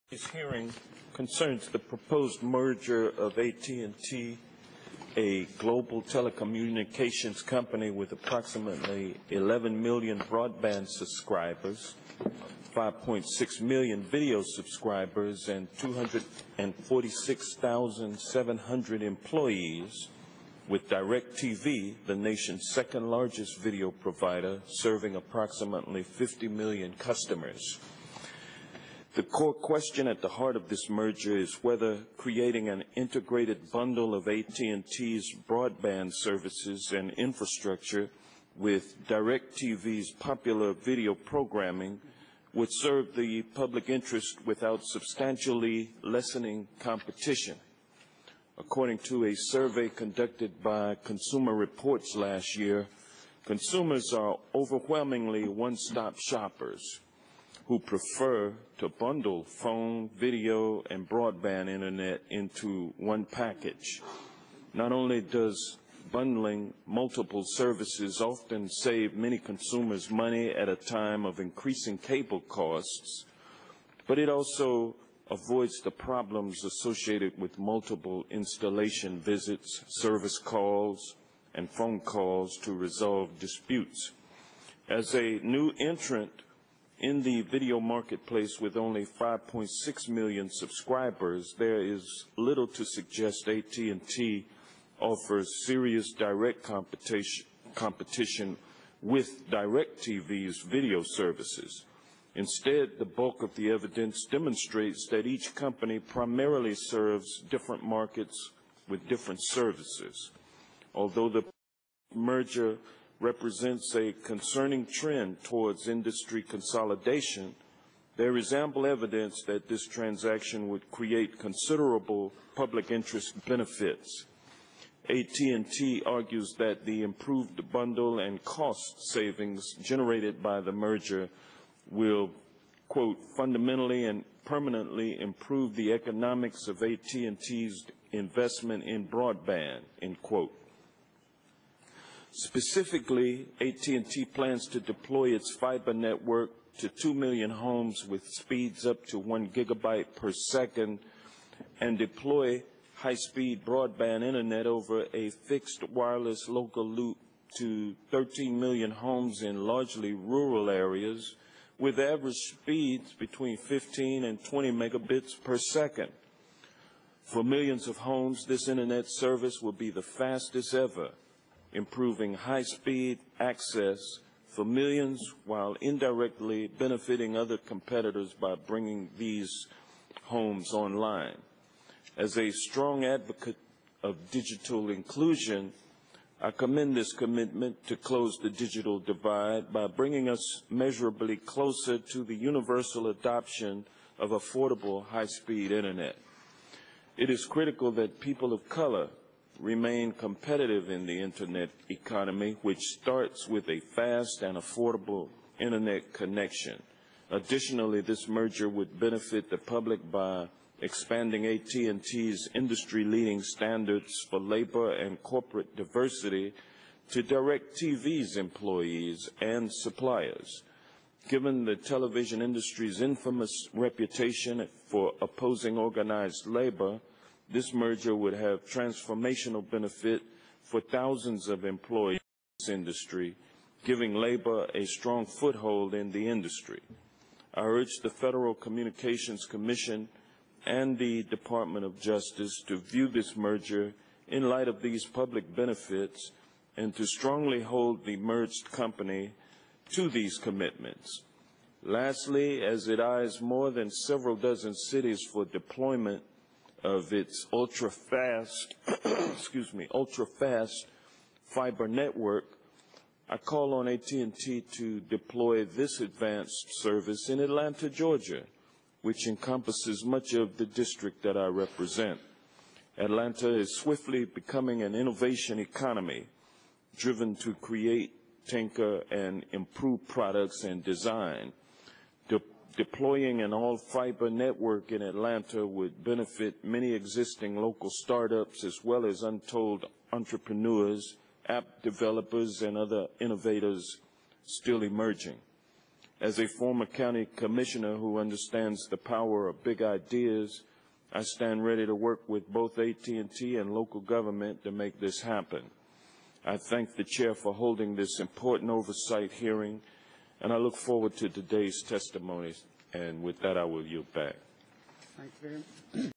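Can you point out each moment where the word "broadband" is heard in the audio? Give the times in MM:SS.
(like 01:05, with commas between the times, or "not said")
00:10, 00:35, 01:01, 02:19, 02:33.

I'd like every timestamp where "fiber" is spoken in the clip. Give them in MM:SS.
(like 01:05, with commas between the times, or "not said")
02:25, 04:21, 04:43.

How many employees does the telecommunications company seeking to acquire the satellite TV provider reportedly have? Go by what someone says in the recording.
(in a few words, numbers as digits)
246,700.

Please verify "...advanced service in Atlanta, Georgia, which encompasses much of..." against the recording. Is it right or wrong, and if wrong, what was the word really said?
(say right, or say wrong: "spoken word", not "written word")
right.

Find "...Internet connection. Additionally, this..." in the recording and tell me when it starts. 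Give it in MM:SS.
03:25.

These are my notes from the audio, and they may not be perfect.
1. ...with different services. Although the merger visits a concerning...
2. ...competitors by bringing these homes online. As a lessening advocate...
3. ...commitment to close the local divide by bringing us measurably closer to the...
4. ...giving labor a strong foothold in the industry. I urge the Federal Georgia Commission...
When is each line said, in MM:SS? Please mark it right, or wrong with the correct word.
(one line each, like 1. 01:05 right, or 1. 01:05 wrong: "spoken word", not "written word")
1. 01:48 wrong: "represents", not "visits"
2. 02:57 wrong: "strong", not "lessening"
3. 03:07 wrong: "digital", not "local"
4. 03:53 wrong: "Communications", not "Georgia".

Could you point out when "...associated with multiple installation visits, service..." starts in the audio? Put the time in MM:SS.
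01:16.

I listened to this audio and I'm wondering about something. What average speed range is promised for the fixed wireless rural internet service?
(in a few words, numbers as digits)
15 to 20 megabits per second.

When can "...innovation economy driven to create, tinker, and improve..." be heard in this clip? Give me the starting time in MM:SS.
04:34.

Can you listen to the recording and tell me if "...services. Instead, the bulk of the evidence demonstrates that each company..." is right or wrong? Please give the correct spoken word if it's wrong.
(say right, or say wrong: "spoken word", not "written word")
right.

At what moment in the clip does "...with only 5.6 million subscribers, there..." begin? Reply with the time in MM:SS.
01:28.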